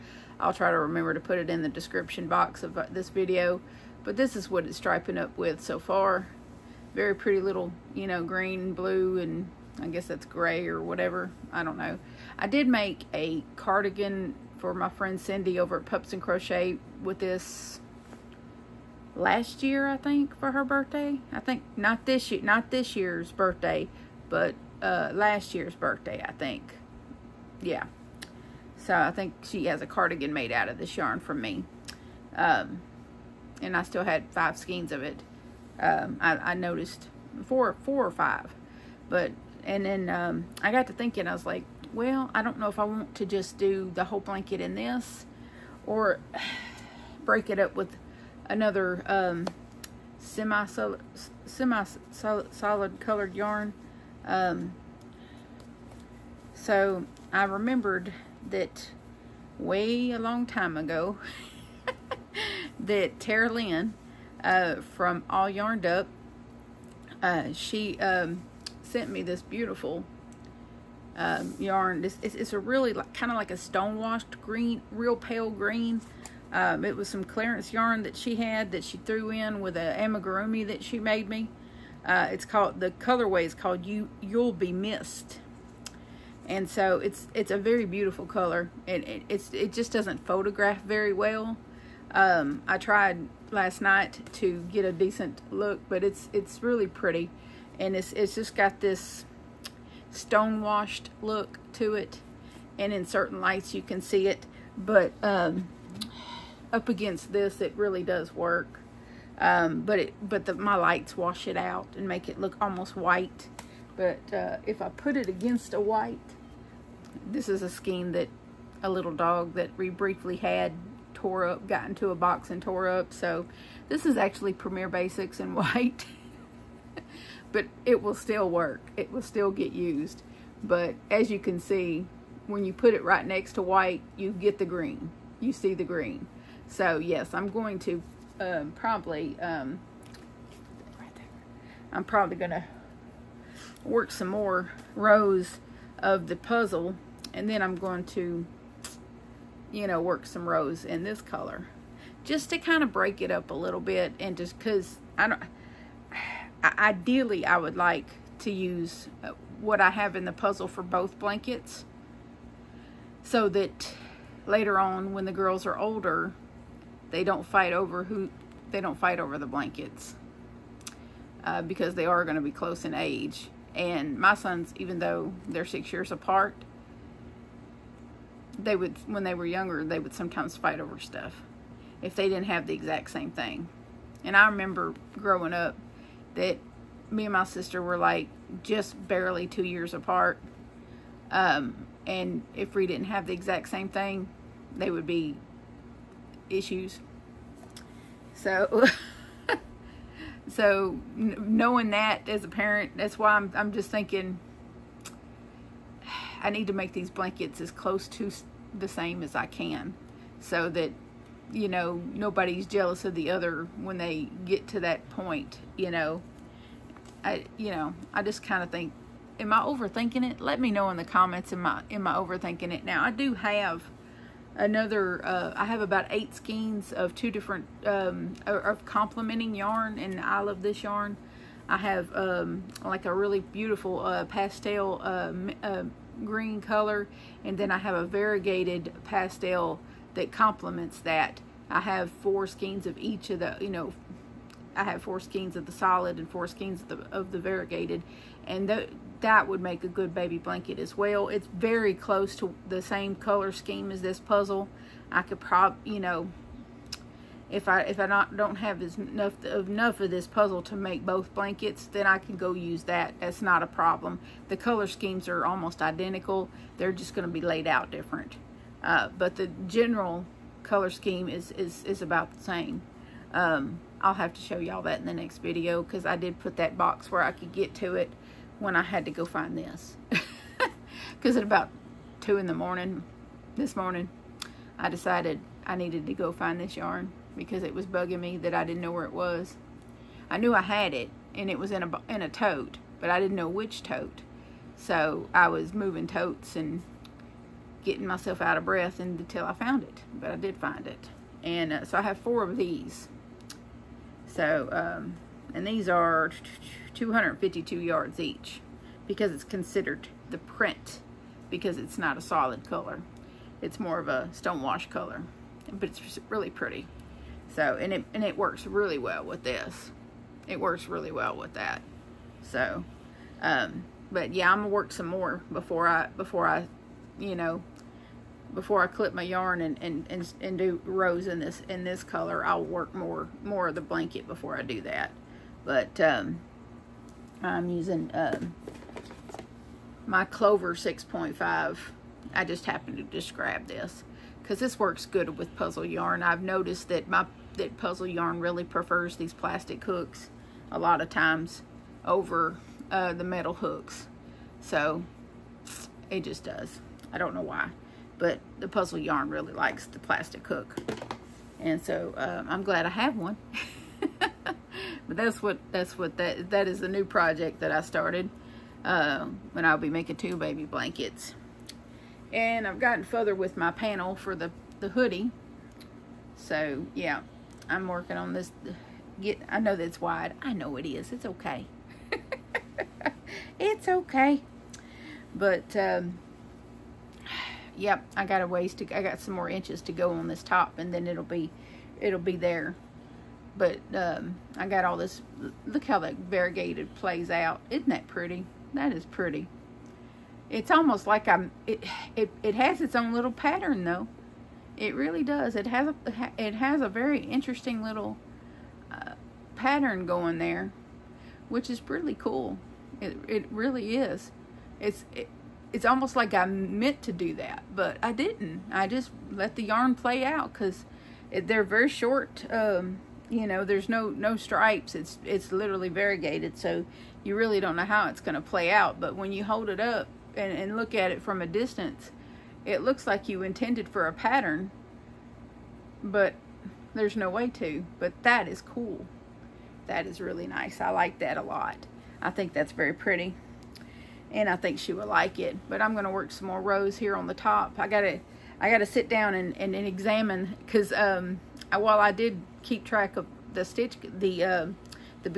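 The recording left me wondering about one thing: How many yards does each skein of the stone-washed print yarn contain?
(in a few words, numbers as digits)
252.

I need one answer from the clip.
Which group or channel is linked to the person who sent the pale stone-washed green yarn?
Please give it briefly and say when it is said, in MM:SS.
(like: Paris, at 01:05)
All Yarned Up, at 01:05.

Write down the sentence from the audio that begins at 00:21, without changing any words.
I think not this year, not this year's birthday, but uh, last year's birthday, I think.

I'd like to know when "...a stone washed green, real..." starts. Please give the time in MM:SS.
01:13.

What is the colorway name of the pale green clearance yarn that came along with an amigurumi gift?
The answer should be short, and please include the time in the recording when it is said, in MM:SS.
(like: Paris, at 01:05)
You'll Be Missed, at 01:24.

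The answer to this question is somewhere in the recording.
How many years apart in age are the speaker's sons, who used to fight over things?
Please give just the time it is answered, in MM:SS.
02:55.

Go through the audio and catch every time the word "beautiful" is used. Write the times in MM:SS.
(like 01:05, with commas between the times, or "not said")
01:09, 01:27, 03:53.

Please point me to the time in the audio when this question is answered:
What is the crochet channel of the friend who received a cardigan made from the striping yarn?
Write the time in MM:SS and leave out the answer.
00:15.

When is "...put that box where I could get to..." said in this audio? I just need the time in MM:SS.
04:36.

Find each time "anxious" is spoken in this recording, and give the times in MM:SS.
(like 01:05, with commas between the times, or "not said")
not said.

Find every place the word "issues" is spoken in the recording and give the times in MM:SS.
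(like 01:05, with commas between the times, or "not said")
03:16.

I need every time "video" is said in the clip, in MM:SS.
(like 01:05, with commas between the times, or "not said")
00:03, 04:35.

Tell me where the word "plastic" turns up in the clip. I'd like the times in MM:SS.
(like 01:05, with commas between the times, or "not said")
05:49, 05:59.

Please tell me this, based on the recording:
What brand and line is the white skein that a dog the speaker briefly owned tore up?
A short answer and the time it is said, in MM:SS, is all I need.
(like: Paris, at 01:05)
Premier Basics, at 02:04.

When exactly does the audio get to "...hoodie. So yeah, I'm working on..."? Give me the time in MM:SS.
06:14.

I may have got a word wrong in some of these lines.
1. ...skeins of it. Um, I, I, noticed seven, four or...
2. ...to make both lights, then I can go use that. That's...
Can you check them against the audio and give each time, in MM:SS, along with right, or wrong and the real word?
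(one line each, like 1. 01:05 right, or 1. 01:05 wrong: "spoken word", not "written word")
1. 00:34 wrong: "four", not "seven"
2. 04:20 wrong: "blankets", not "lights".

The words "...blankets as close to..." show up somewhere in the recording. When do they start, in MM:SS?
03:27.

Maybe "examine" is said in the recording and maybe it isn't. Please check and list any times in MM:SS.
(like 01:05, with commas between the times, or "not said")
07:29.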